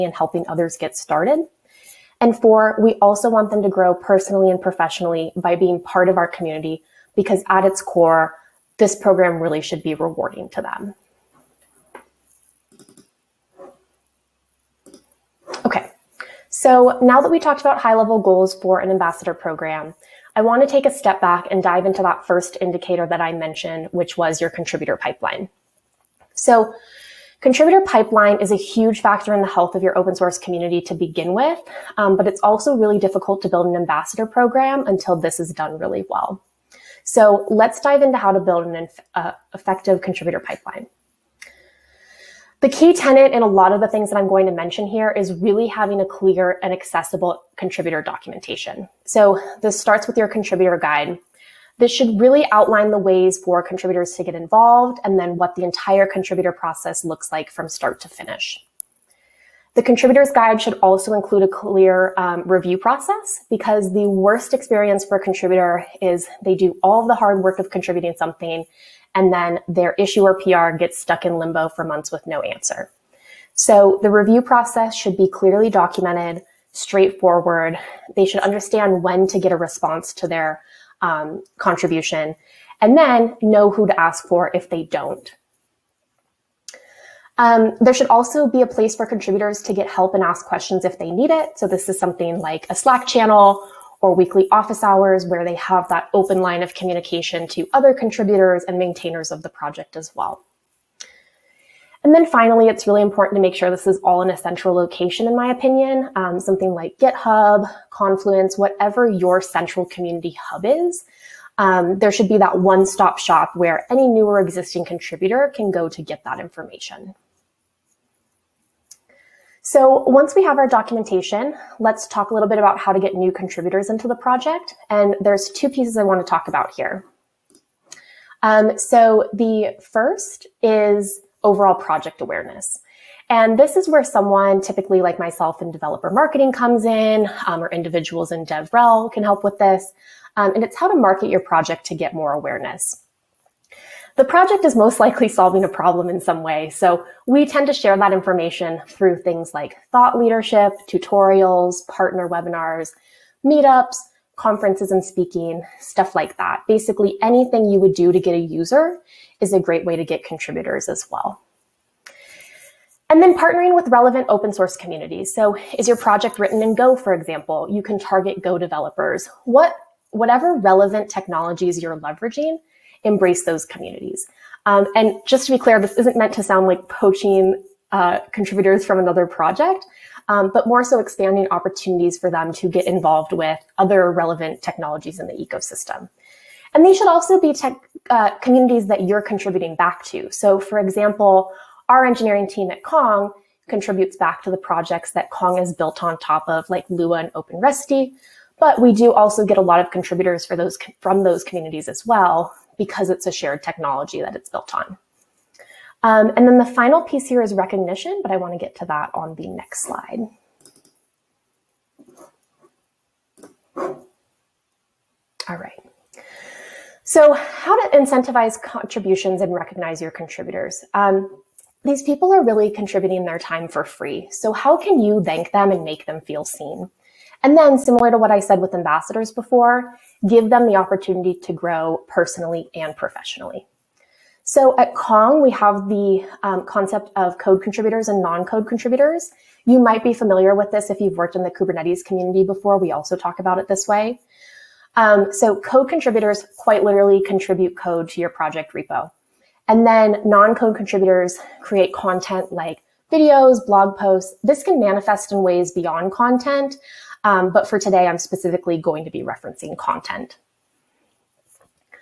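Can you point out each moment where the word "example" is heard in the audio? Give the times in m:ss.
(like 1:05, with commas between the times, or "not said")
2:47, 3:10.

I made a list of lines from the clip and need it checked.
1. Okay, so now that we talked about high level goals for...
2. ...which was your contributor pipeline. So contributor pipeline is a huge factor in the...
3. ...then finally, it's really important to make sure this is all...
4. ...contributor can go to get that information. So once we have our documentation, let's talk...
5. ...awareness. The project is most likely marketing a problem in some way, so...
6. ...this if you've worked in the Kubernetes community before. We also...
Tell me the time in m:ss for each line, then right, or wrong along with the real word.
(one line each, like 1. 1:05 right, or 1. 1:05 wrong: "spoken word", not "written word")
1. 0:15 right
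2. 0:23 right
3. 1:42 right
4. 1:54 right
5. 2:22 wrong: "solving", not "marketing"
6. 4:00 right.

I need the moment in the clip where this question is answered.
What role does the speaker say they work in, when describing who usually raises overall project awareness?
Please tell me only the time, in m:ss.
2:15.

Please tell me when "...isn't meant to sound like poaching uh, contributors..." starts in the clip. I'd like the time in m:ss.
2:55.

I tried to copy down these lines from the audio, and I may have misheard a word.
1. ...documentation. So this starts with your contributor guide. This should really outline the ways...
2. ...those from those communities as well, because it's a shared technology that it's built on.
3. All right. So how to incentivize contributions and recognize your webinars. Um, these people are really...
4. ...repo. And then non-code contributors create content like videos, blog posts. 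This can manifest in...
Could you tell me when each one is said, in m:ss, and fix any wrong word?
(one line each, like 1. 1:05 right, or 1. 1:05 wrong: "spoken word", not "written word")
1. 0:48 right
2. 3:20 right
3. 3:35 wrong: "contributors", not "webinars"
4. 4:08 right.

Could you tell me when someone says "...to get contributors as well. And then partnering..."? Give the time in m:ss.
2:39.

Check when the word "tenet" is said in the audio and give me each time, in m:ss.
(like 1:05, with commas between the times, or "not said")
0:42.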